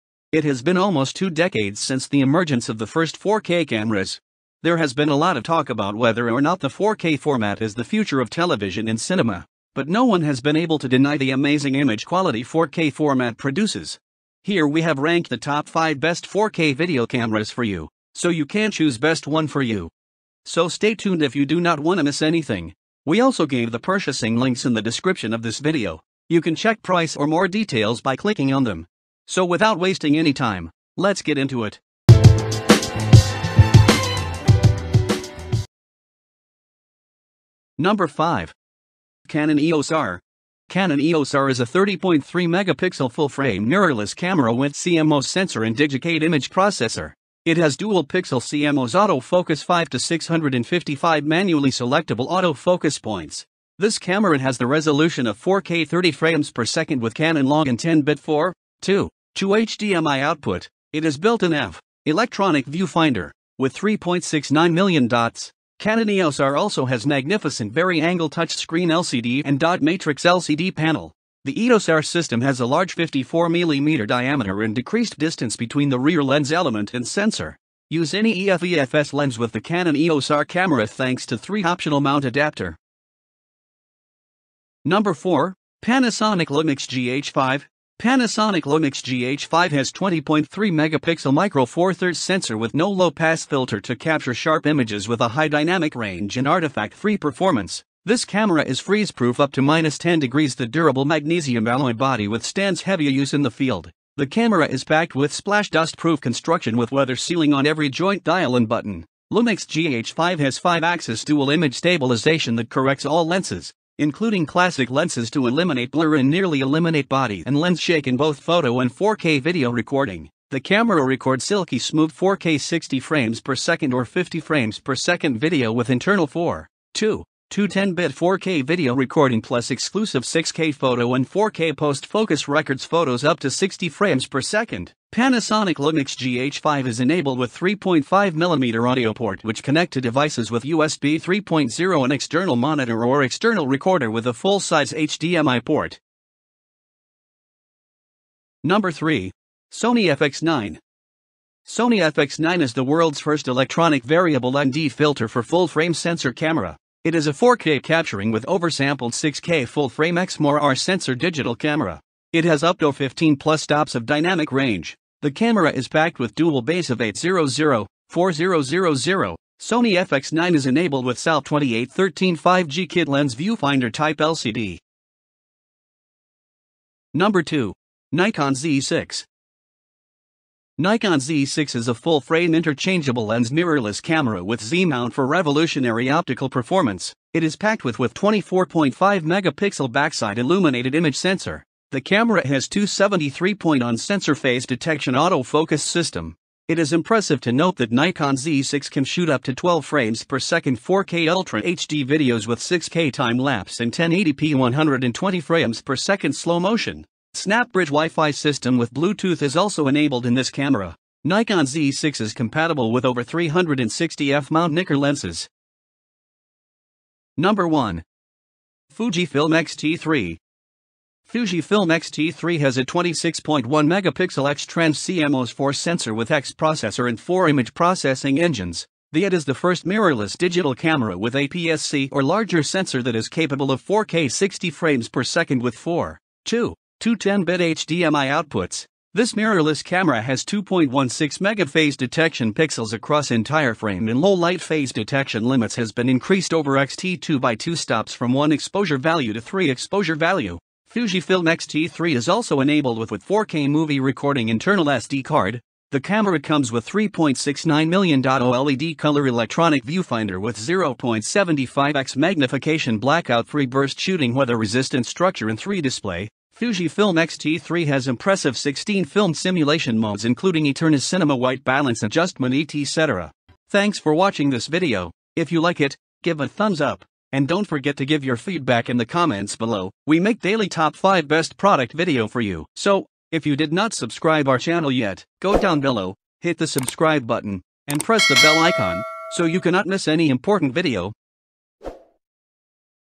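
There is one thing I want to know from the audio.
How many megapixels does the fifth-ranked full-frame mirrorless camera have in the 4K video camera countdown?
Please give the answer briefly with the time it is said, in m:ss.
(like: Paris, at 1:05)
30.3 megapixel, at 0:41.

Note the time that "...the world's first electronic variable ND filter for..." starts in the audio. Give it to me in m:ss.
2:32.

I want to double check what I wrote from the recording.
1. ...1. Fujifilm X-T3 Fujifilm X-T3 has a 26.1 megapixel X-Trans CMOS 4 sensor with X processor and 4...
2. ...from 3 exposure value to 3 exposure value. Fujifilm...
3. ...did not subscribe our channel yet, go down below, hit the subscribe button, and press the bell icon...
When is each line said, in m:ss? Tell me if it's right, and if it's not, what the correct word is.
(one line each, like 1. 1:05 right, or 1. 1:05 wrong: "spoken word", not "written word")
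1. 3:37 right
2. 4:08 wrong: "1", not "3"
3. 4:43 right.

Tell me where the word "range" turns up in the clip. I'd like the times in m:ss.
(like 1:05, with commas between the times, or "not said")
1:35, 2:44.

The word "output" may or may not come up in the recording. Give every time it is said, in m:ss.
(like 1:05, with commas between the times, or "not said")
1:00, 3:58.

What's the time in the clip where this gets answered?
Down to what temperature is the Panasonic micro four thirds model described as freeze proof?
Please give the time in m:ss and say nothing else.
1:39.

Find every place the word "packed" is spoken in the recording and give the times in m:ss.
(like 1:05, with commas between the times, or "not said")
1:44, 2:45, 3:07.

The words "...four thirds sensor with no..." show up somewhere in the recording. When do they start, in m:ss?
1:31.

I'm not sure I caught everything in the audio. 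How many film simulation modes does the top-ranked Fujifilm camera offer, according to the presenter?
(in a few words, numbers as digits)
16.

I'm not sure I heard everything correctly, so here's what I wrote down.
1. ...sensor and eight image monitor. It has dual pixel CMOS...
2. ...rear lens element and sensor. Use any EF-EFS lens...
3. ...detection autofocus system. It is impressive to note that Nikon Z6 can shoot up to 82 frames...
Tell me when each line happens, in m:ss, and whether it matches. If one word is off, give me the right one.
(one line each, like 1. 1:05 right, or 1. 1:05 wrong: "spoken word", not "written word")
1. 0:45 wrong: "processor", not "monitor"
2. 1:15 right
3. 3:14 wrong: "12", not "82".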